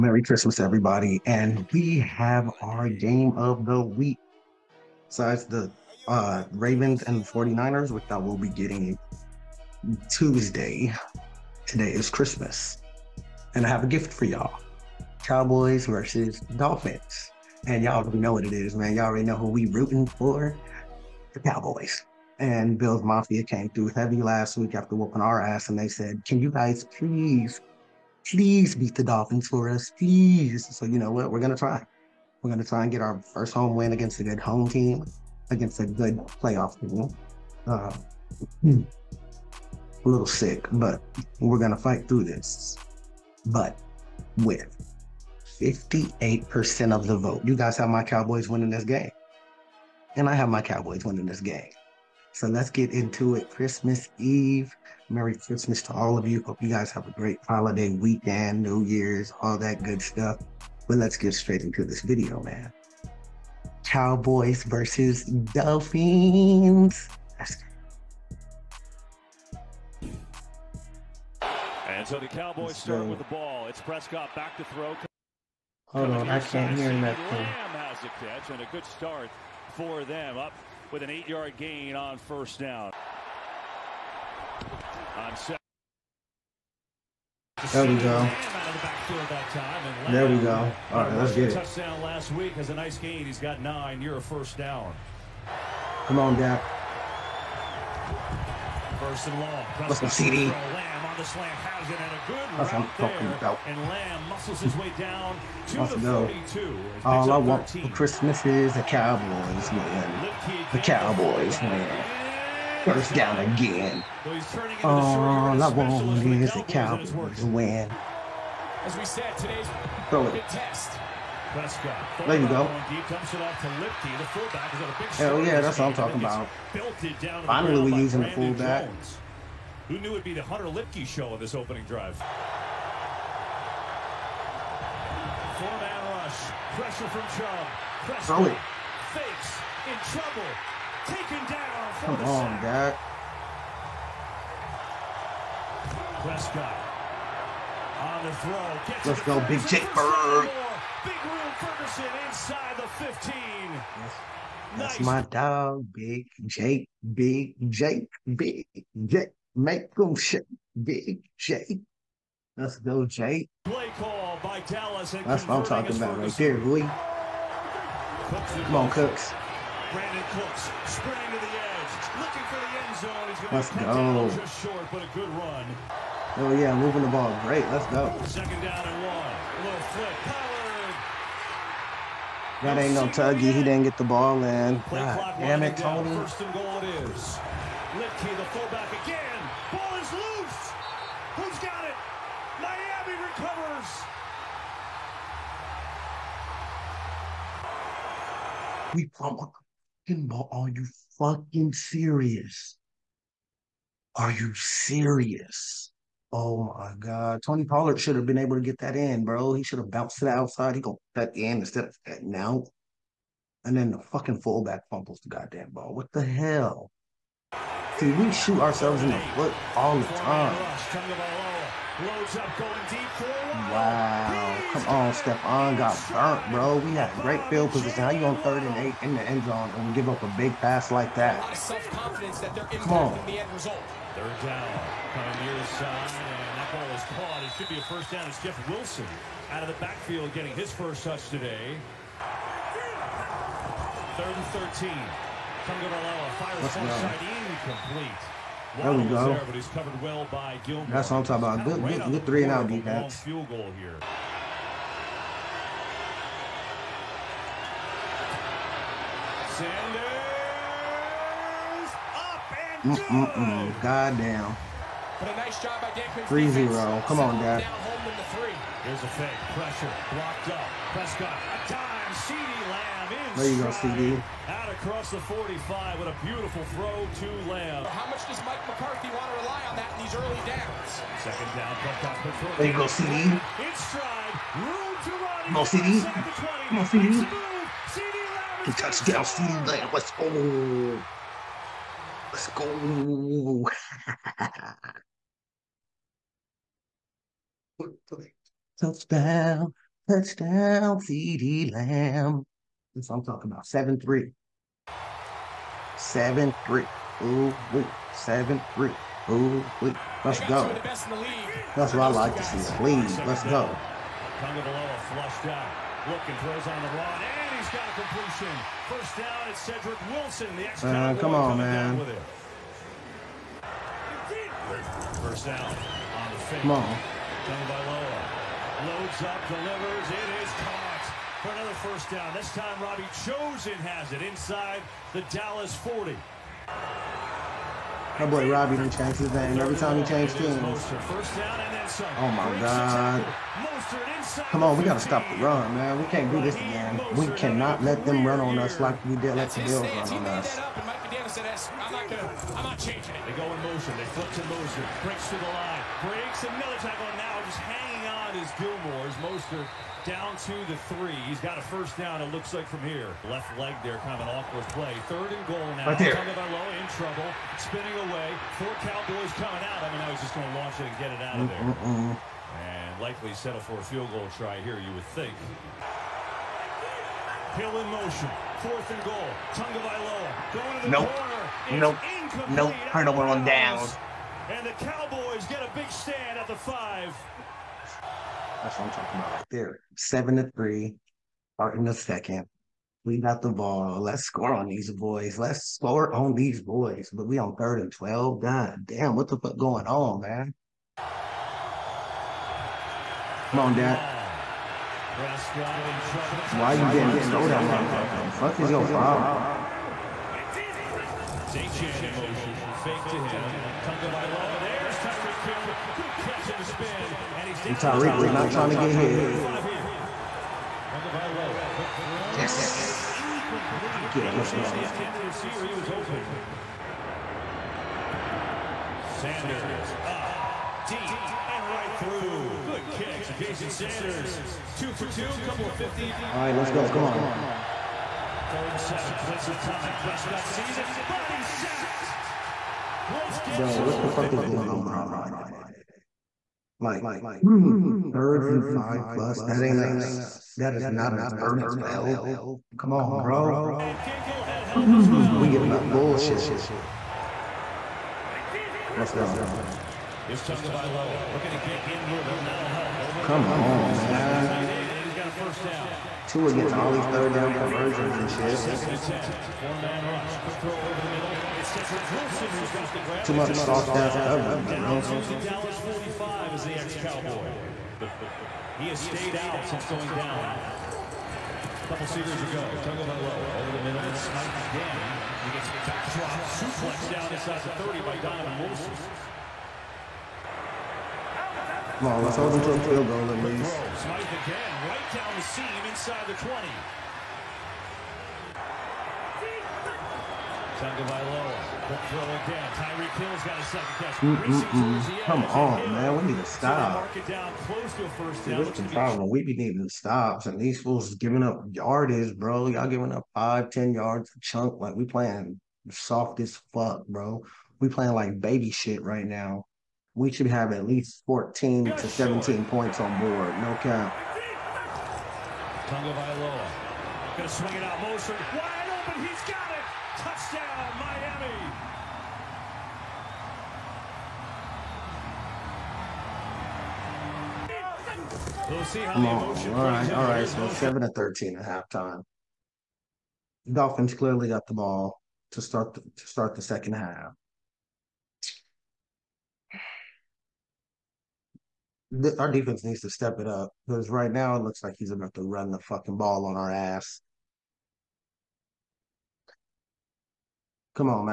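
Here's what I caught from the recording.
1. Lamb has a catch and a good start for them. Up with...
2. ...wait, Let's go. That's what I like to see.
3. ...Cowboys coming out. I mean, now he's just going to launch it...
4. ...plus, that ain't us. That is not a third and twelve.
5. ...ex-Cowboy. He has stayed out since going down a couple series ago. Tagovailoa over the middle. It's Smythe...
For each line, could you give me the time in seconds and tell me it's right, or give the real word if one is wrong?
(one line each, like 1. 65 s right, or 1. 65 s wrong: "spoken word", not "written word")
1. 77 s right
2. 309 s right
3. 368 s right
4. 449 s right
5. 476 s right.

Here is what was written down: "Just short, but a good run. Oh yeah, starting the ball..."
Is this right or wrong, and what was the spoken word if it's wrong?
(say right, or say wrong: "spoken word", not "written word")
wrong: "moving", not "starting".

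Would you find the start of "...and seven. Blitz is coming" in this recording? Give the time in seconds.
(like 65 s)
438 s.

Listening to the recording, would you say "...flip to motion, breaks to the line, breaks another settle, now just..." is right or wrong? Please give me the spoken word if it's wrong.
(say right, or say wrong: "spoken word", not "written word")
wrong: "tackle", not "settle".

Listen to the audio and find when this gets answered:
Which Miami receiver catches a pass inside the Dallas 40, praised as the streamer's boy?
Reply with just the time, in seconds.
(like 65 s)
332 s.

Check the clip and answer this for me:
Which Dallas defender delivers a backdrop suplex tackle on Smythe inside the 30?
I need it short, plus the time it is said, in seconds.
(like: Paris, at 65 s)
Donovan Wilson, at 488 s.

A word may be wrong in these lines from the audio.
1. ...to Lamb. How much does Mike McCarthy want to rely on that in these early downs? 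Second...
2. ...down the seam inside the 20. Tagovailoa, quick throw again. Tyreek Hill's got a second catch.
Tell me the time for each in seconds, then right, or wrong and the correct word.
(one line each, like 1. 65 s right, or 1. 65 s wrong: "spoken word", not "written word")
1. 277 s right
2. 495 s right.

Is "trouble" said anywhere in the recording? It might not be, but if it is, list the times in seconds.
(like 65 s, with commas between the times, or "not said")
140 s, 366 s.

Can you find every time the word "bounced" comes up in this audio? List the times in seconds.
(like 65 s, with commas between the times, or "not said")
209 s.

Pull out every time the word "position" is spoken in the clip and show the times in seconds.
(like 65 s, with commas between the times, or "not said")
227 s.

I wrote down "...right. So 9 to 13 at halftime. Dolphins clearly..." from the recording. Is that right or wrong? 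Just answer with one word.
wrong.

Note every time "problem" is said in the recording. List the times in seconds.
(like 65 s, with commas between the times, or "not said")
408 s, 508 s.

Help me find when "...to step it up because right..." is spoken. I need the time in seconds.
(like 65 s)
553 s.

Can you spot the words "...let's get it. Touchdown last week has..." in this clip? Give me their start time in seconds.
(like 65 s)
91 s.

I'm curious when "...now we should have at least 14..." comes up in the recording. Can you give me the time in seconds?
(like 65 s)
519 s.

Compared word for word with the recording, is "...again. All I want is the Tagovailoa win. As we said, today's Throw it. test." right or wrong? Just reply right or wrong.
wrong.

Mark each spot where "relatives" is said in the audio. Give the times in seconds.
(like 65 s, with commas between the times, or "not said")
not said.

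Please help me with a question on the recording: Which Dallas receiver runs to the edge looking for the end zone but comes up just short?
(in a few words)
Brandin Cooks.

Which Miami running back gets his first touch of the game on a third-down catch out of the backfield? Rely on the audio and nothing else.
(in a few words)
Jeff Wilson.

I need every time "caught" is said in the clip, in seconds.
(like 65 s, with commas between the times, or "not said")
237 s, 330 s.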